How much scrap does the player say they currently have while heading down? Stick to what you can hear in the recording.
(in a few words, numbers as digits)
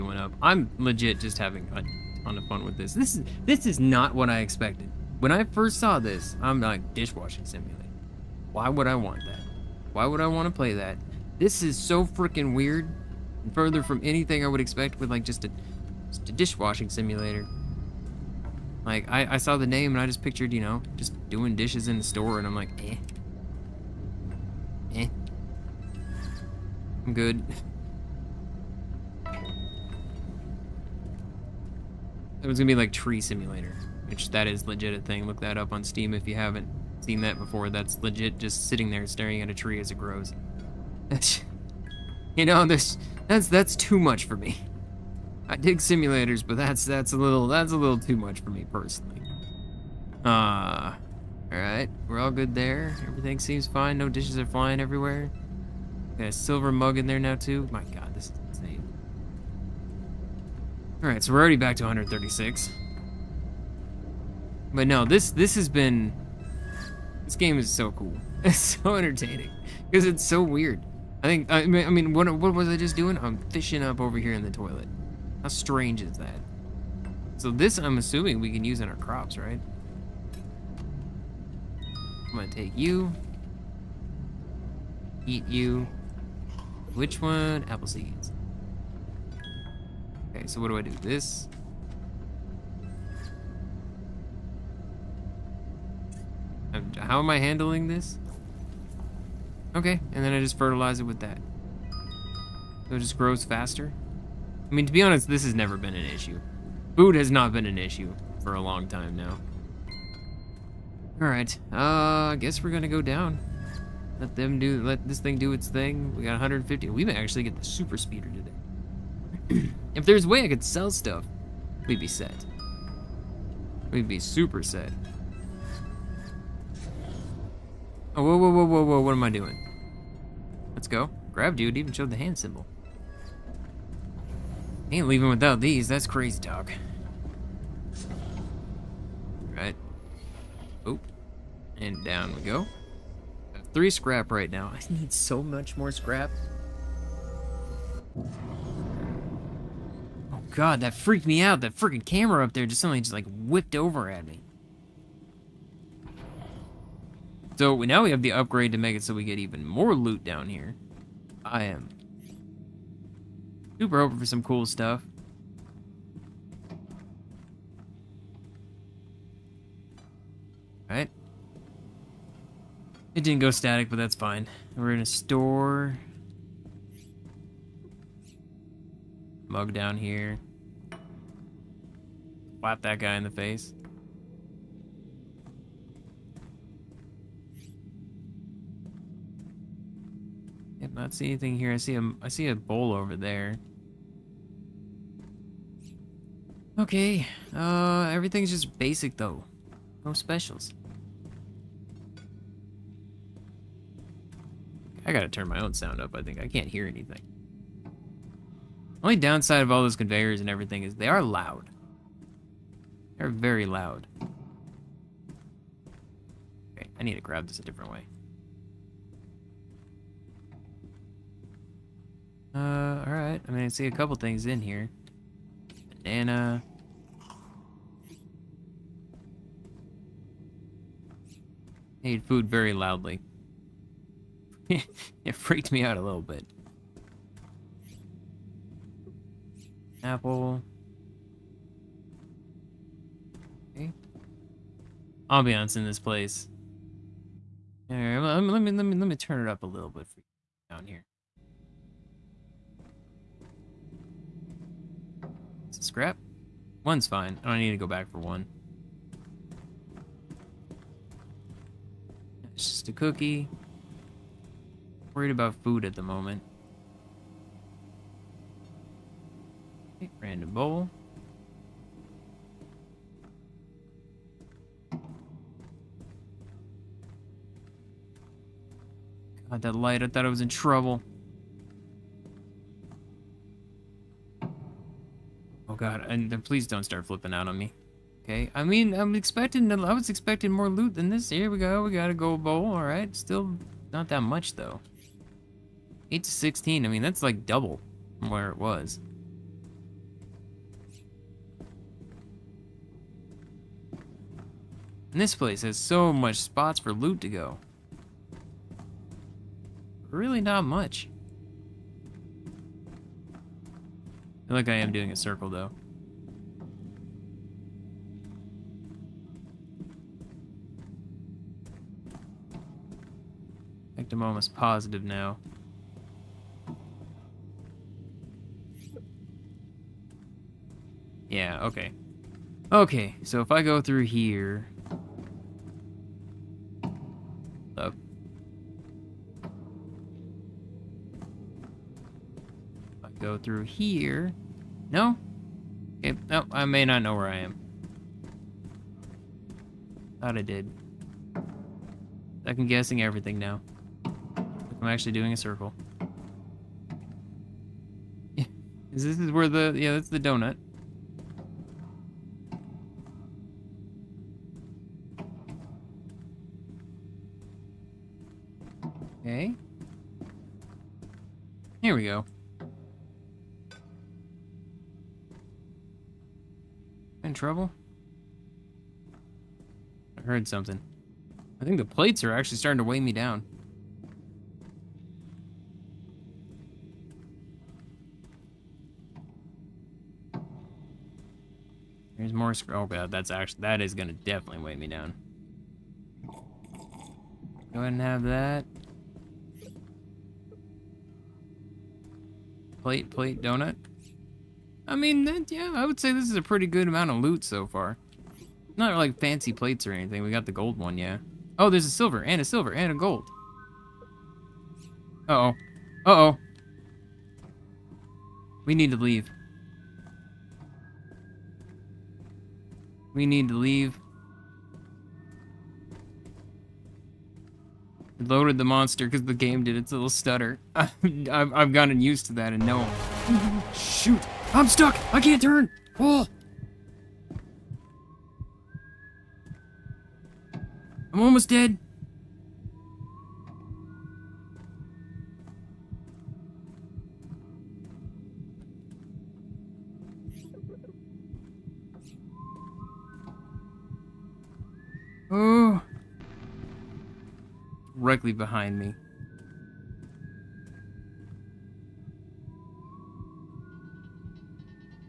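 3.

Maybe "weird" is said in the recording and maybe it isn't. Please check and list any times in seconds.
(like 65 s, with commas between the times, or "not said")
12 s, 70 s.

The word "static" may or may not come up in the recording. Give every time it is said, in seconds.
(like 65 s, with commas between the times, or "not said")
173 s.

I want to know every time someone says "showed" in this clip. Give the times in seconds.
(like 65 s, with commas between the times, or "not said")
131 s.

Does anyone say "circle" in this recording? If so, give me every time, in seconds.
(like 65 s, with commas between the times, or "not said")
315 s, 355 s.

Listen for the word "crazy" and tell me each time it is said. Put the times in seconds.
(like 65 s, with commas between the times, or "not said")
136 s.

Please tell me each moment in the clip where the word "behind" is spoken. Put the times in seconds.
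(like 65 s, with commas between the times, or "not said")
458 s.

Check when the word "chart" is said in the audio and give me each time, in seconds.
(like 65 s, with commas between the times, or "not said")
not said.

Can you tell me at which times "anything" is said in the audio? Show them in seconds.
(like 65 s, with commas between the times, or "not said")
14 s, 191 s, 206 s, 409 s.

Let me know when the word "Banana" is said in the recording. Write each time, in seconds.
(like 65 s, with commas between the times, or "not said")
226 s.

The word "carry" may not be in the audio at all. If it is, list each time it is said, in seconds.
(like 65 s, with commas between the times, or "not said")
not said.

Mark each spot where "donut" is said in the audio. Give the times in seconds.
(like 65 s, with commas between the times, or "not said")
360 s, 403 s.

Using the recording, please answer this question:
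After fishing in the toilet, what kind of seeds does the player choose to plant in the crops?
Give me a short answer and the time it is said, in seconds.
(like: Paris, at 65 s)
Apple seeds, at 87 s.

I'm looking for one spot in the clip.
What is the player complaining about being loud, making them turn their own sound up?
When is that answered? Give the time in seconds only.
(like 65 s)
209 s.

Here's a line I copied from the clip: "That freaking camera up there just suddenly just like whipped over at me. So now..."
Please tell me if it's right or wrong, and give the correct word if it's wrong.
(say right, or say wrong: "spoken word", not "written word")
right.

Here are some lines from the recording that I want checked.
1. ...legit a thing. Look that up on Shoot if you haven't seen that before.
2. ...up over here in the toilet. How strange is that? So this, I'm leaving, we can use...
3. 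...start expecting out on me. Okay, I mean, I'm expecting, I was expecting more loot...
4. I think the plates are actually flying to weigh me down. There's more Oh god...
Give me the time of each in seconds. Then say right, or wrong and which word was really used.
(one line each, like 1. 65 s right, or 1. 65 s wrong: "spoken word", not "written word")
1. 34 s wrong: "Steam", not "Shoot"
2. 73 s wrong: "assuming", not "leaving"
3. 286 s wrong: "flipping", not "expecting"
4. 381 s wrong: "starting", not "flying".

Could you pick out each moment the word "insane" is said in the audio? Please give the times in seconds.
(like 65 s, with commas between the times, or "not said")
58 s.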